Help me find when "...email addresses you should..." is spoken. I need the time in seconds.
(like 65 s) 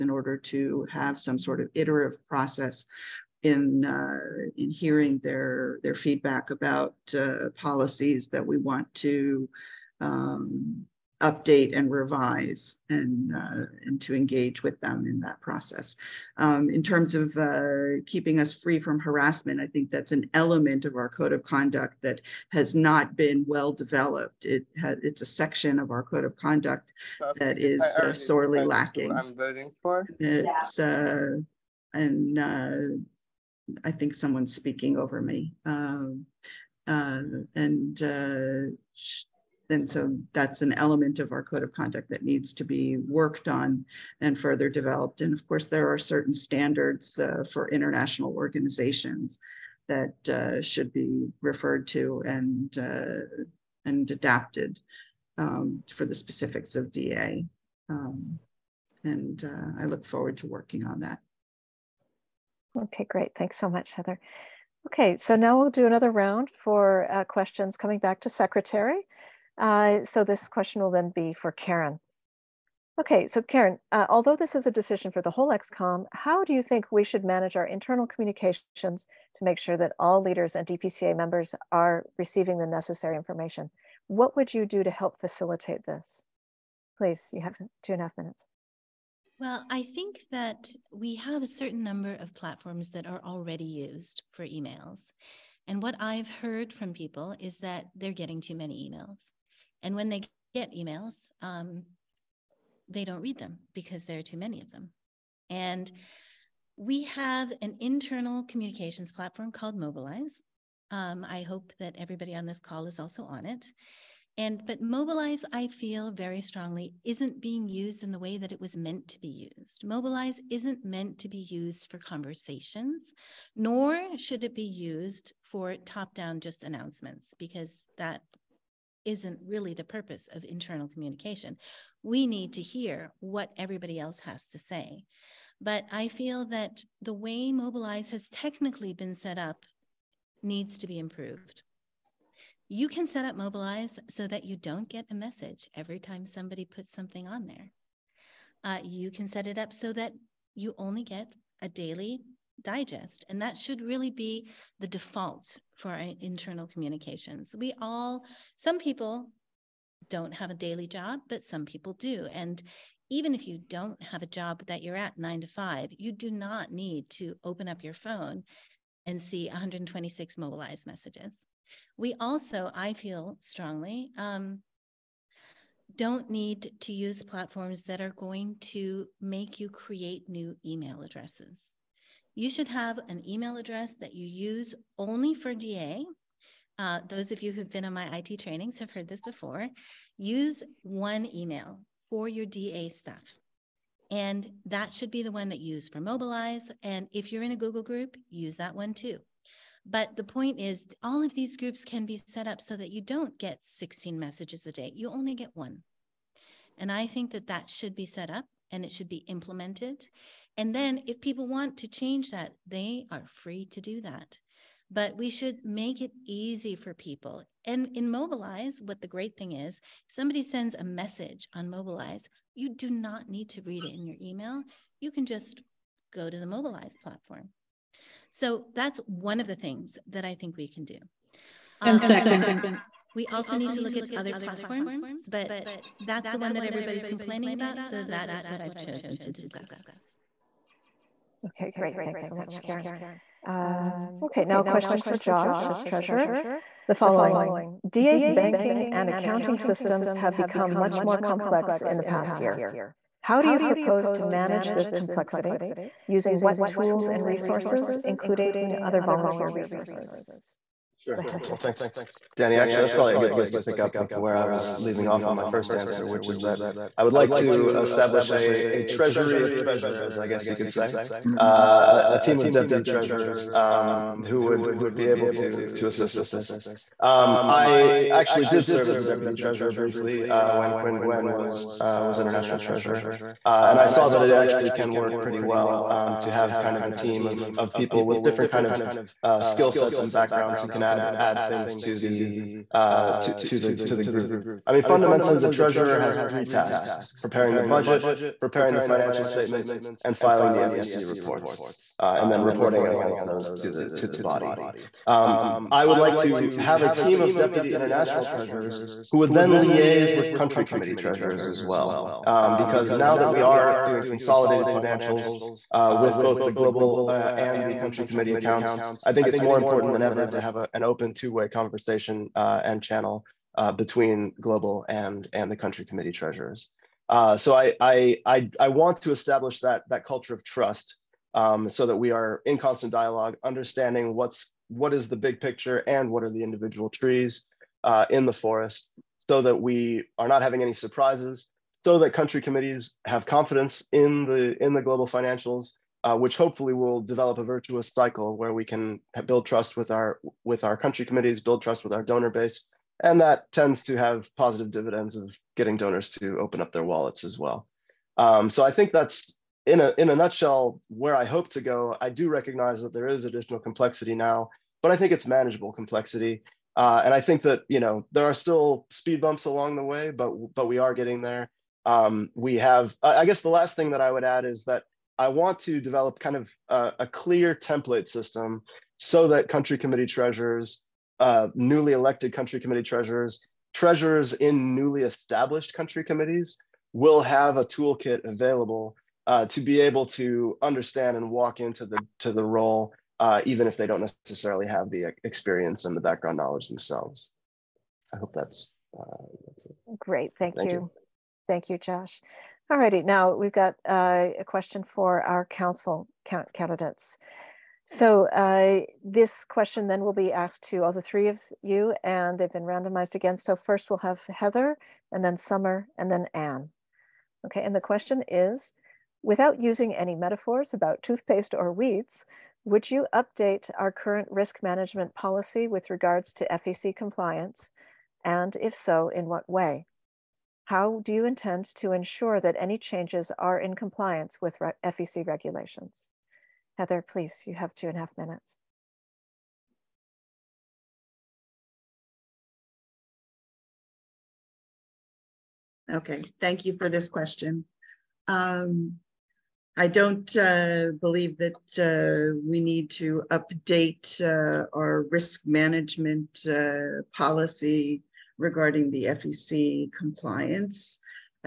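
180 s.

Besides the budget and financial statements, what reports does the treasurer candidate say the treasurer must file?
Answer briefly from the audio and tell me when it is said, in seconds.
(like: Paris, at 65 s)
FEC reports, at 300 s.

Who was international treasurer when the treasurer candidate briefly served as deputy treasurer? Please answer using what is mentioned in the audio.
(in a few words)
Quinn Gwen.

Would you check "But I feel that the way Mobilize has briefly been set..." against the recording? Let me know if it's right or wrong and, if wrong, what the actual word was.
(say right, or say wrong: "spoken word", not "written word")
wrong: "technically", not "briefly".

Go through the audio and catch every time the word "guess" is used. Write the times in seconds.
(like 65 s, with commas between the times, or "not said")
270 s, 373 s.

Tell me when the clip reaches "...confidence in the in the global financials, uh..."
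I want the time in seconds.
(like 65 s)
343 s.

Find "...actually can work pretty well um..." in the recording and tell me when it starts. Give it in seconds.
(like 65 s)
284 s.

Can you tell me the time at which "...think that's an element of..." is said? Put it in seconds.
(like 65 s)
19 s.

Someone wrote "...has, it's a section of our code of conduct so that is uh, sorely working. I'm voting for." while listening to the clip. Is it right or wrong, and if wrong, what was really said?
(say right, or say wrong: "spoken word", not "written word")
wrong: "lacking", not "working".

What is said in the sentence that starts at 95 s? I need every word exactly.
And what I've heard from people is that they're getting too many emails.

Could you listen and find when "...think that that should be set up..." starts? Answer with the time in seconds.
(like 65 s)
207 s.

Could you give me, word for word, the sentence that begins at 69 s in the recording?
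Uh, so this question will then be for Karen.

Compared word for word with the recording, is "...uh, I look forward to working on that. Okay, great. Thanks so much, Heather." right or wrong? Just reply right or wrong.
right.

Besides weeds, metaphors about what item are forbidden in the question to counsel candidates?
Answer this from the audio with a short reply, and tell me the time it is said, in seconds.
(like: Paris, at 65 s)
toothpaste, at 421 s.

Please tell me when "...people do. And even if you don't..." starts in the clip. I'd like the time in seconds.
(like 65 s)
161 s.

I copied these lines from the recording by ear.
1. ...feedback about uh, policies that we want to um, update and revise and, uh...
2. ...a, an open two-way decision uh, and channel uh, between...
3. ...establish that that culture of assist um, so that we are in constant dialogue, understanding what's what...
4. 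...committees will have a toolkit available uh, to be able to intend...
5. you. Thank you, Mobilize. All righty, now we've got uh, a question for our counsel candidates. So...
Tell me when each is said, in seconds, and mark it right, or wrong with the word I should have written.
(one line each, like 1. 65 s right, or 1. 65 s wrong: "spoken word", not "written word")
1. 5 s right
2. 320 s wrong: "conversation", not "decision"
3. 329 s wrong: "trust", not "assist"
4. 386 s wrong: "understand", not "intend"
5. 400 s wrong: "Josh", not "Mobilize".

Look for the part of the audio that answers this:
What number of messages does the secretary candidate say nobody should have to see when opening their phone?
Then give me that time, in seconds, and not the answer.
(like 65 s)
169 s.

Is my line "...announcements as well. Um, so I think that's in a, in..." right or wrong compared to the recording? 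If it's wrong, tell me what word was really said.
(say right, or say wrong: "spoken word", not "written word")
wrong: "wallets", not "announcements".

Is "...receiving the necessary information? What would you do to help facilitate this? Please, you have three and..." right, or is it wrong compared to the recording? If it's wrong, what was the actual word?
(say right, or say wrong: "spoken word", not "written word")
wrong: "two", not "three".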